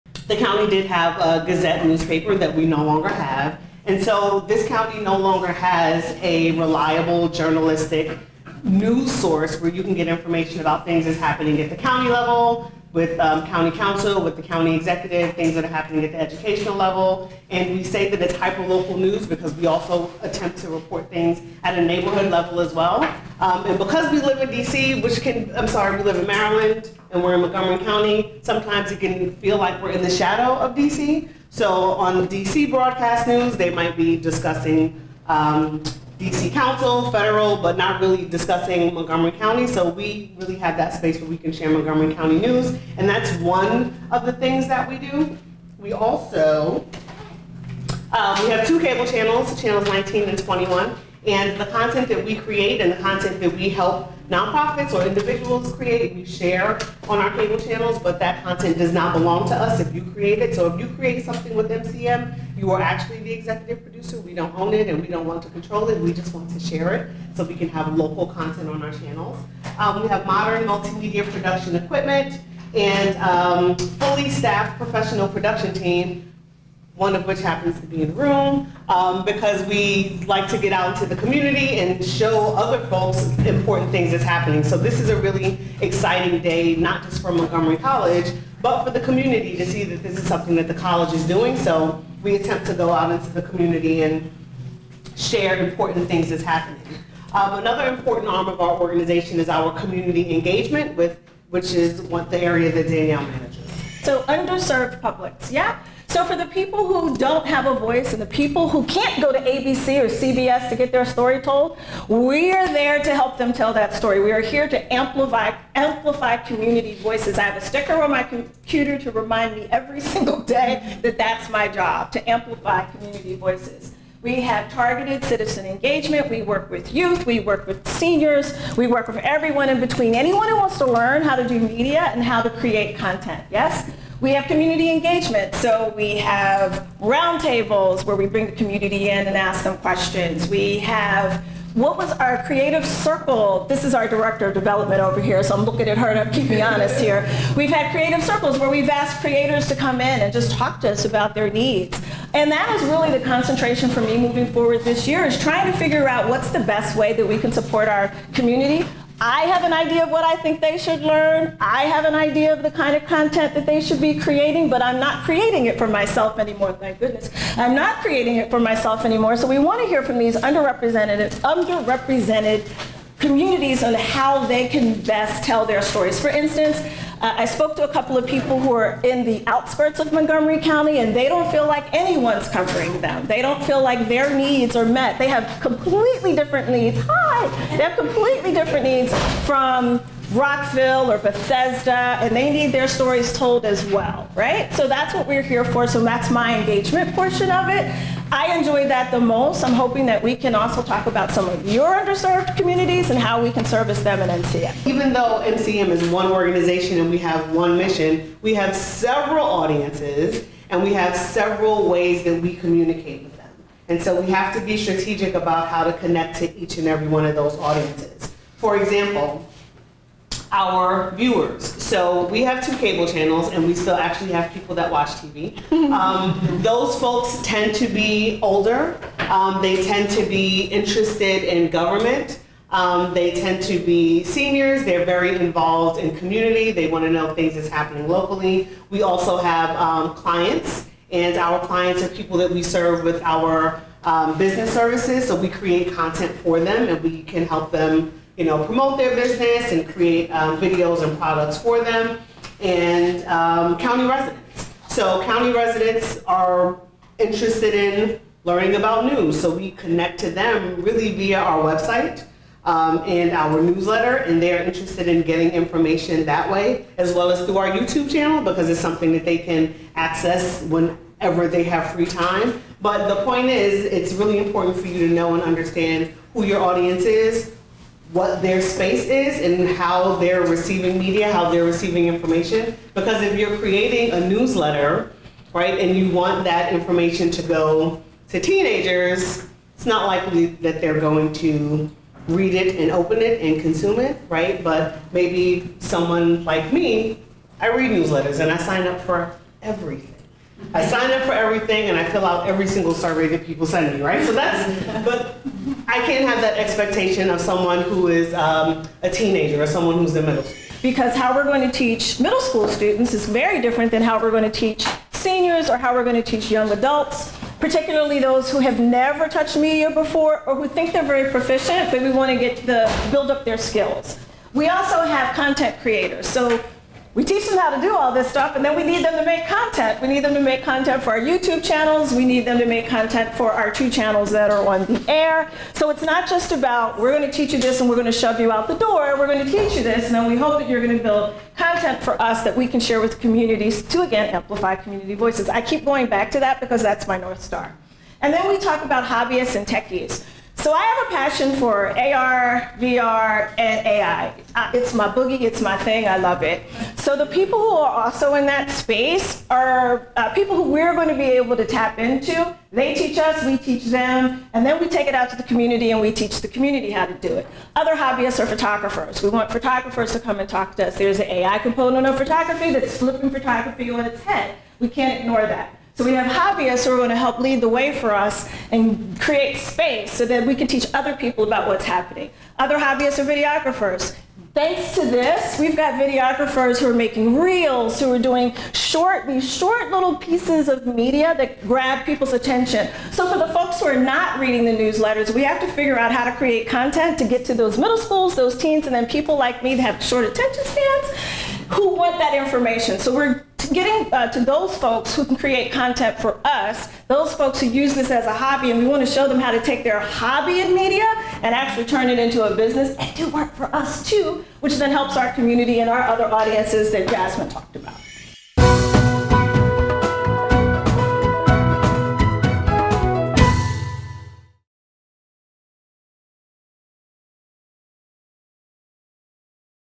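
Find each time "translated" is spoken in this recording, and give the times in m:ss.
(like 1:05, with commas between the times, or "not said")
not said.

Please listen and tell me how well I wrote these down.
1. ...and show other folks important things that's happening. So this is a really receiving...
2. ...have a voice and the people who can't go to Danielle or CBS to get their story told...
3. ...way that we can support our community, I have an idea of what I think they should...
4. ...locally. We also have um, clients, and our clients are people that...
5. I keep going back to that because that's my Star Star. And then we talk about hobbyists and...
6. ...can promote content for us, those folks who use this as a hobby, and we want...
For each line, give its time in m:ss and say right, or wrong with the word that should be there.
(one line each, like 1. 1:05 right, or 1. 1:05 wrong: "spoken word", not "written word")
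1. 1:21 wrong: "exciting", not "receiving"
2. 1:47 wrong: "ABC", not "Danielle"
3. 2:36 right
4. 3:58 right
5. 5:45 wrong: "North", not "Star"
6. 6:45 wrong: "create", not "promote".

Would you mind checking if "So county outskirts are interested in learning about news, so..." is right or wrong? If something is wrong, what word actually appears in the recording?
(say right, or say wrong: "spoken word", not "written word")
wrong: "residents", not "outskirts".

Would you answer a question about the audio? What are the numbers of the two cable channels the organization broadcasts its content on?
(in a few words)
19 and 21.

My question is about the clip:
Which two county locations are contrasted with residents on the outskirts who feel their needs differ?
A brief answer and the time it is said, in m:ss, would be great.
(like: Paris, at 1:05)
Rockville or Bethesda, at 3:10.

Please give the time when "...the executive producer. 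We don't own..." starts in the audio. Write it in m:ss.
1:03.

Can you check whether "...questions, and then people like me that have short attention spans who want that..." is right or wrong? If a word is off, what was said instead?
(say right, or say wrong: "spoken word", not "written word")
wrong: "teens", not "questions".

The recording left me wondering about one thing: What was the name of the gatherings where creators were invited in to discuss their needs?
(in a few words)
Creative circles.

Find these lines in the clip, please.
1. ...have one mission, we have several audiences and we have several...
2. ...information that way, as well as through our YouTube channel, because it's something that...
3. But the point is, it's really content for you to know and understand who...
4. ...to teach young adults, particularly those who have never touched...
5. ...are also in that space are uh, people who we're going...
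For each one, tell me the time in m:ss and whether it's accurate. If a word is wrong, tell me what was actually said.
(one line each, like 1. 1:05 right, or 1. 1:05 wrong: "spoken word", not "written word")
1. 3:27 right
2. 4:25 right
3. 4:32 wrong: "important", not "content"
4. 5:16 right
5. 5:57 right.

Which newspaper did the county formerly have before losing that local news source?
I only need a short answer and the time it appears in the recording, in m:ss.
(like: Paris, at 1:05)
Gazette, at 0:01.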